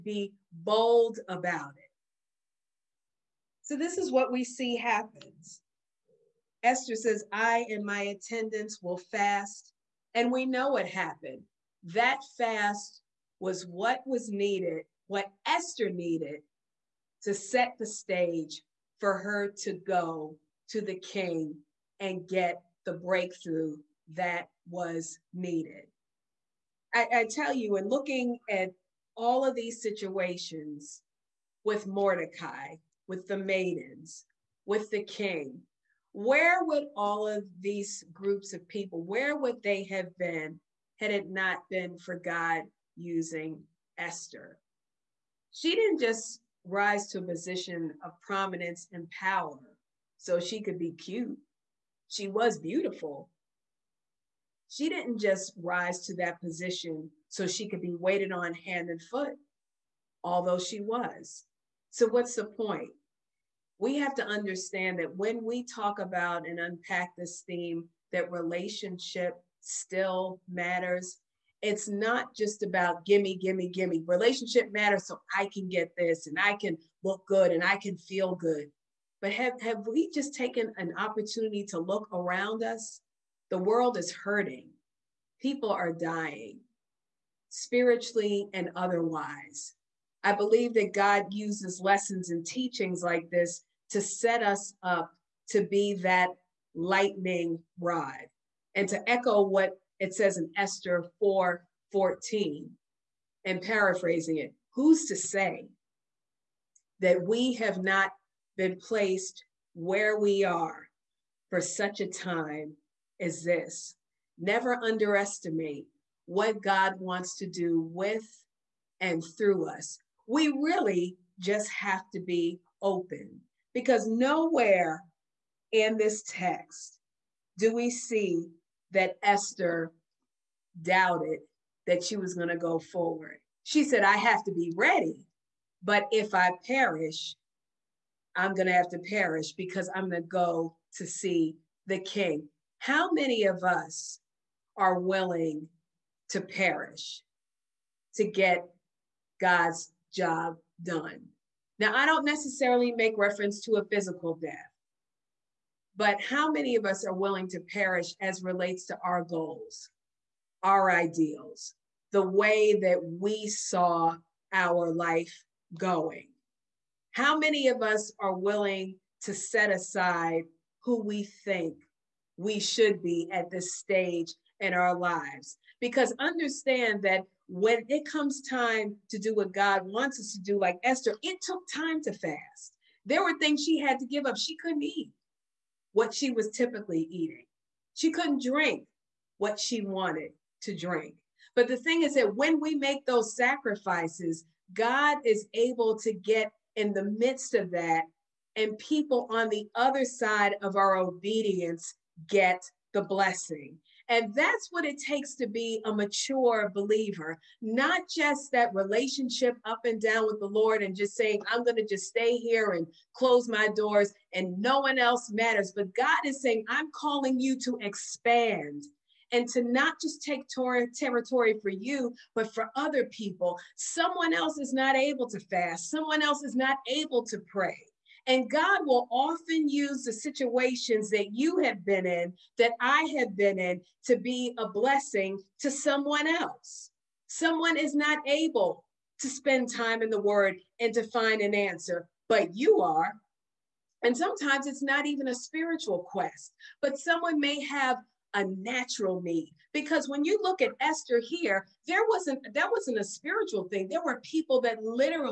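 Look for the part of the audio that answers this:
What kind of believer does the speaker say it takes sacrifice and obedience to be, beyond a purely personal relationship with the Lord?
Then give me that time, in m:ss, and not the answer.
3:25.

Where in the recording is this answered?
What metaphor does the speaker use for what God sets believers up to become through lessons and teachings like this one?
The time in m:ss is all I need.
1:36.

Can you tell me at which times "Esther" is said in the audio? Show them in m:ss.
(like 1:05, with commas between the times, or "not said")
0:06, 0:15, 0:43, 1:40, 2:09, 3:00, 4:10.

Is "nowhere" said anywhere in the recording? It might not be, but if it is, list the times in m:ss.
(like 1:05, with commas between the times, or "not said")
2:04.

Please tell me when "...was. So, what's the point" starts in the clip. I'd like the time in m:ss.
1:00.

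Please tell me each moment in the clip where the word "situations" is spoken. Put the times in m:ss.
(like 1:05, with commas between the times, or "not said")
0:29, 3:50.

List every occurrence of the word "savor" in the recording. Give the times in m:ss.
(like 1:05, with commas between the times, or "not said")
not said.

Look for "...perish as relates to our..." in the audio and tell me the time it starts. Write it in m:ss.
2:37.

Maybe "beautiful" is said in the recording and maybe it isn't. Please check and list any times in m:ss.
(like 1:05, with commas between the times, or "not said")
0:52.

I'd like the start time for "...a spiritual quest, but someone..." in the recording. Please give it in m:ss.
4:05.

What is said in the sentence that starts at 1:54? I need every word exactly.
Never underestimate what God wants to do with and through us.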